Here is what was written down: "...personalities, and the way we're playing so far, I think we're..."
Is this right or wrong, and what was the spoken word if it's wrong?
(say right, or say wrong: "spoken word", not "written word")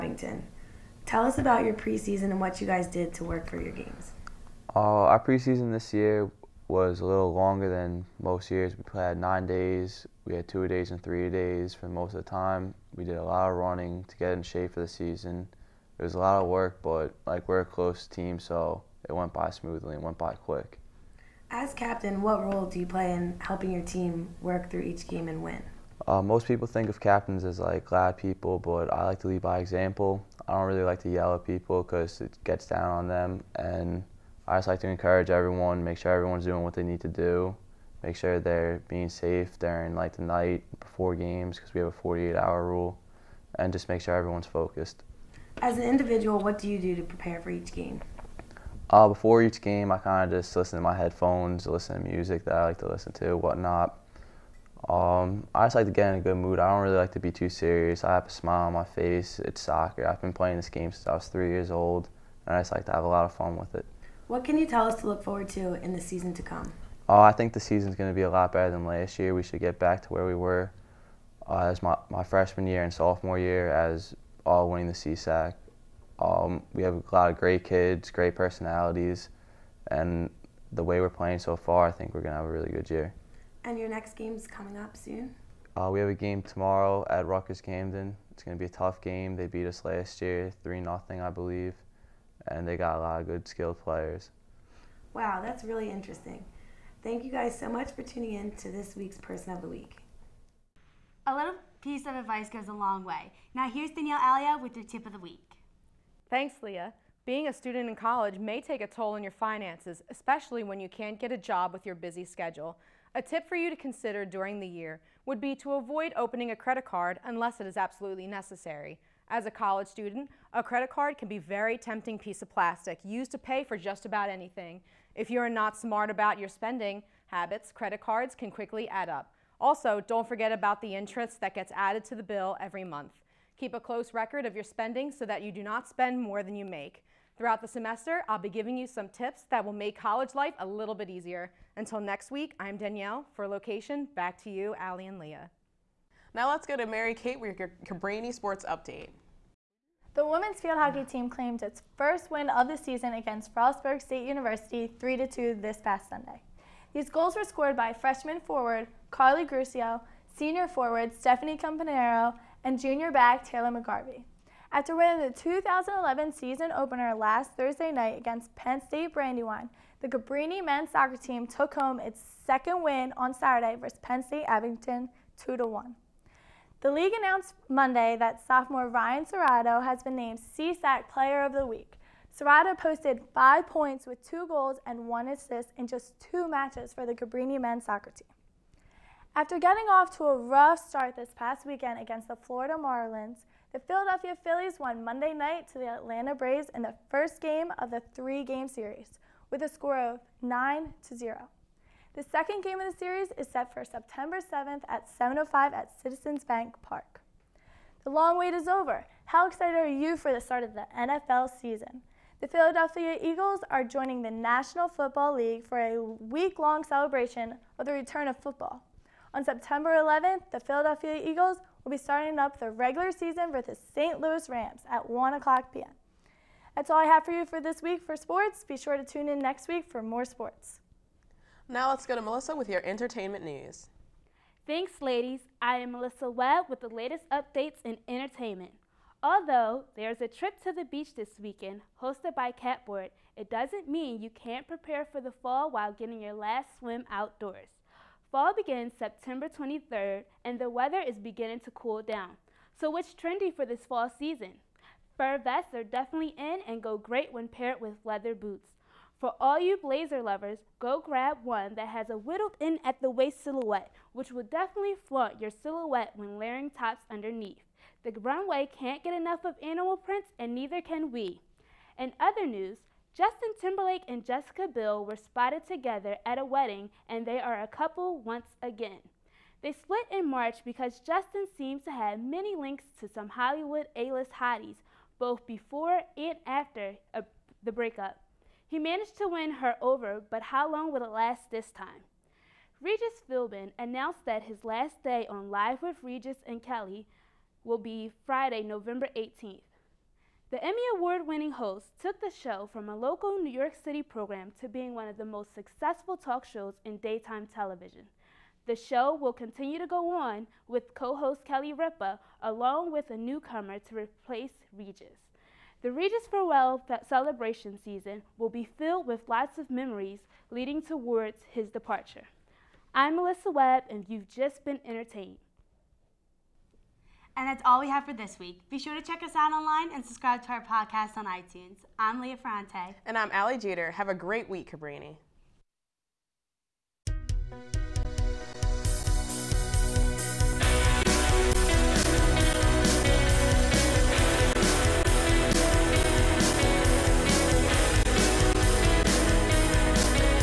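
right.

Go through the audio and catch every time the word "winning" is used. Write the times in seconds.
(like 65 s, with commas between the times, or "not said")
74 s, 164 s, 301 s.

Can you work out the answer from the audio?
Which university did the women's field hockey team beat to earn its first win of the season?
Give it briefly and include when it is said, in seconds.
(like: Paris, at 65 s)
Frostburg State University, at 153 s.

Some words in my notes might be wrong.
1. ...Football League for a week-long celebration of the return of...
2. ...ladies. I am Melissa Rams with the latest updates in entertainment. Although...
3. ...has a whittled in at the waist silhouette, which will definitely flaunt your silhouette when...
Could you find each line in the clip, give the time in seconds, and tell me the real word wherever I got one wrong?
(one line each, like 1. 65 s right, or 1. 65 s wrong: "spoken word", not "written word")
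1. 214 s right
2. 235 s wrong: "Webb", not "Rams"
3. 261 s right.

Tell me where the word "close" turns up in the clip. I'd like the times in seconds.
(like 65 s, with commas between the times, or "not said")
17 s, 133 s.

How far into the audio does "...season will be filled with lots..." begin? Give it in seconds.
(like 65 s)
317 s.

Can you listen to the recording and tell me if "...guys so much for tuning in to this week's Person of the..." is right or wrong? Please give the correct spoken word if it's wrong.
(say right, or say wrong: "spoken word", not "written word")
right.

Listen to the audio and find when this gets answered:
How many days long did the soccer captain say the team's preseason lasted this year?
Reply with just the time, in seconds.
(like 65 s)
9 s.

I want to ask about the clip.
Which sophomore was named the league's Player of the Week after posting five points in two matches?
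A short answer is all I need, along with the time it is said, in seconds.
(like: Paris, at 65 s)
Ryan Serrato, at 178 s.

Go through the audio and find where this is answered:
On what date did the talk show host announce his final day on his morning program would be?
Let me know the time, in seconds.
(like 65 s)
298 s.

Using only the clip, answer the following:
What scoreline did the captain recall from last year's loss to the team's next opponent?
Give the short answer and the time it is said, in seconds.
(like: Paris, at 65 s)
3-0, at 90 s.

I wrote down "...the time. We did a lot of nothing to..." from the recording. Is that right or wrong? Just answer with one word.
wrong.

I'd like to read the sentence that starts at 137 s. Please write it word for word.
Throughout the semester, I'll be giving you some tips that will make college life a little bit easier.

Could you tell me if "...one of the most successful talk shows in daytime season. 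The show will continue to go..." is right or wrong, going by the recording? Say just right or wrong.
wrong.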